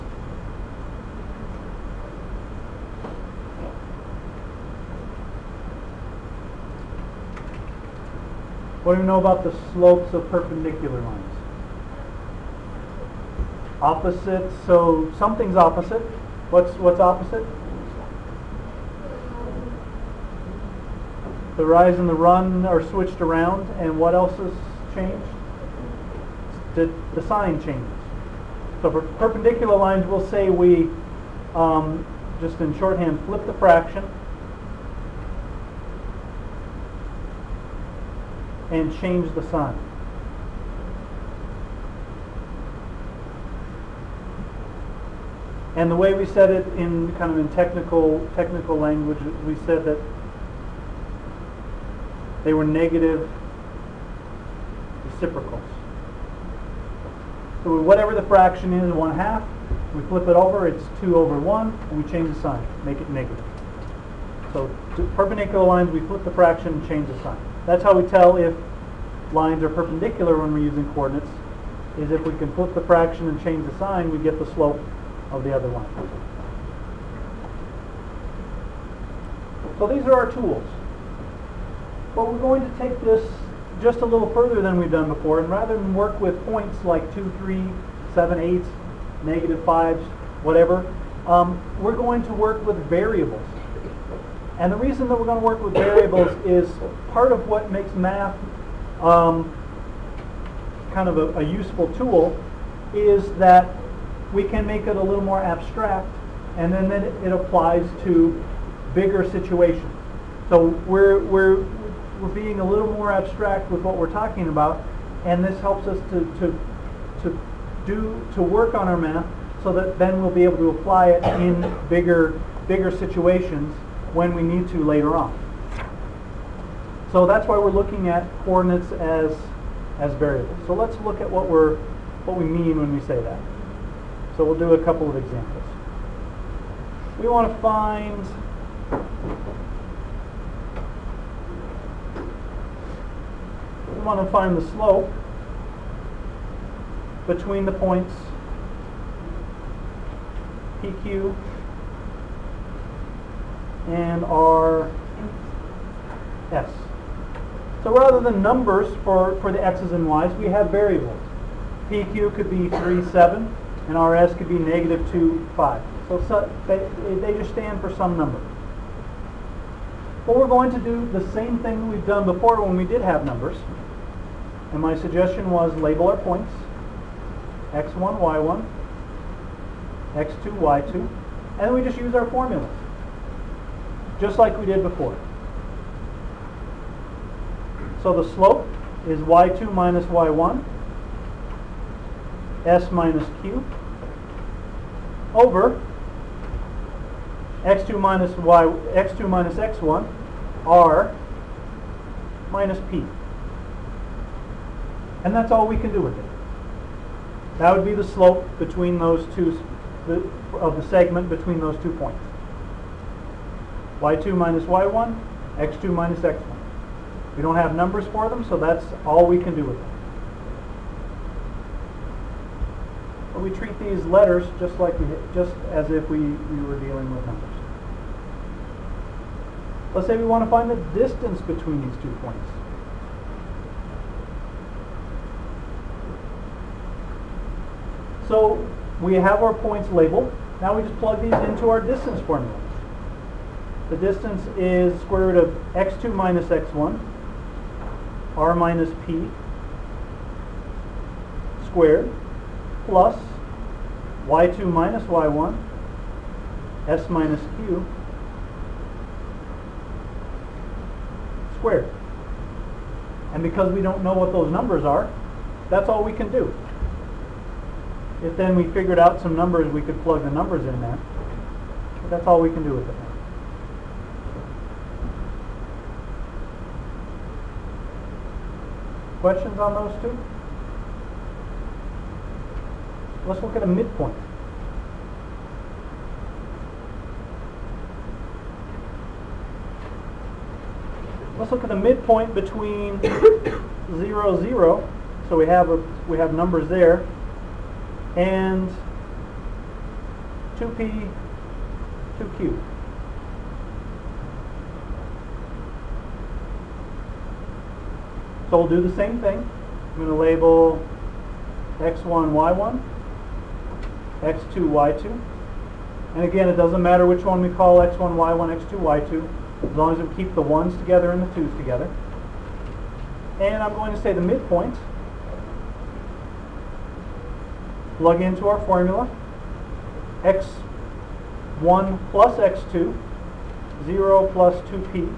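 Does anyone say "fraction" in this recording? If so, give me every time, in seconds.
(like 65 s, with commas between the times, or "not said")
33 s, 58 s, 66 s, 72 s.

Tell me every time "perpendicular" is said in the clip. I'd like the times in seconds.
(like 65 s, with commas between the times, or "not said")
10 s, 29 s, 65 s, 69 s.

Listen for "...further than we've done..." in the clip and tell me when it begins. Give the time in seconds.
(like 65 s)
84 s.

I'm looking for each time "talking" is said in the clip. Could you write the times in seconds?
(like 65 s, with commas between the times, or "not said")
114 s.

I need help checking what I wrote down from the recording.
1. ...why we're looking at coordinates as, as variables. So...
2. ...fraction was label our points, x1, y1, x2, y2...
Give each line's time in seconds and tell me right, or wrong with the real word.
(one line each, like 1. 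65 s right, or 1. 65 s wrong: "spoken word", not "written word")
1. 127 s right
2. 174 s wrong: "suggestion", not "fraction".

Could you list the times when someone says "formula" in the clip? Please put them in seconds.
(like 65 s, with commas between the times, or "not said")
182 s, 242 s, 328 s.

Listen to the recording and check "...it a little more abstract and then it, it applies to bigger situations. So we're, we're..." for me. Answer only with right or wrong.
right.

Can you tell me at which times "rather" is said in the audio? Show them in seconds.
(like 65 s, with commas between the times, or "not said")
85 s, 157 s.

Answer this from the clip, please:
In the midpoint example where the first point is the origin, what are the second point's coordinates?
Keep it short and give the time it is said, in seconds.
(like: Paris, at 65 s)
2p, 2q, at 300 s.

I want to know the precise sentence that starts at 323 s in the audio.
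And I'm going to say the midpoint.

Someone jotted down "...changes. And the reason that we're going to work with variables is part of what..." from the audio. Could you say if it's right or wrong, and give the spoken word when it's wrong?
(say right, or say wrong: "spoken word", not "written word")
wrong: "variables", not "changes".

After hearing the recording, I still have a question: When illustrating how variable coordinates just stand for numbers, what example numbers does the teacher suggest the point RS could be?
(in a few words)
-2, 5.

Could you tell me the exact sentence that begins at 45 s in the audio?
And the way we said it in kind of in technical technical language, we said that they were negative reciprocals.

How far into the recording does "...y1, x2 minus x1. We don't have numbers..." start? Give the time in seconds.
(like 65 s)
214 s.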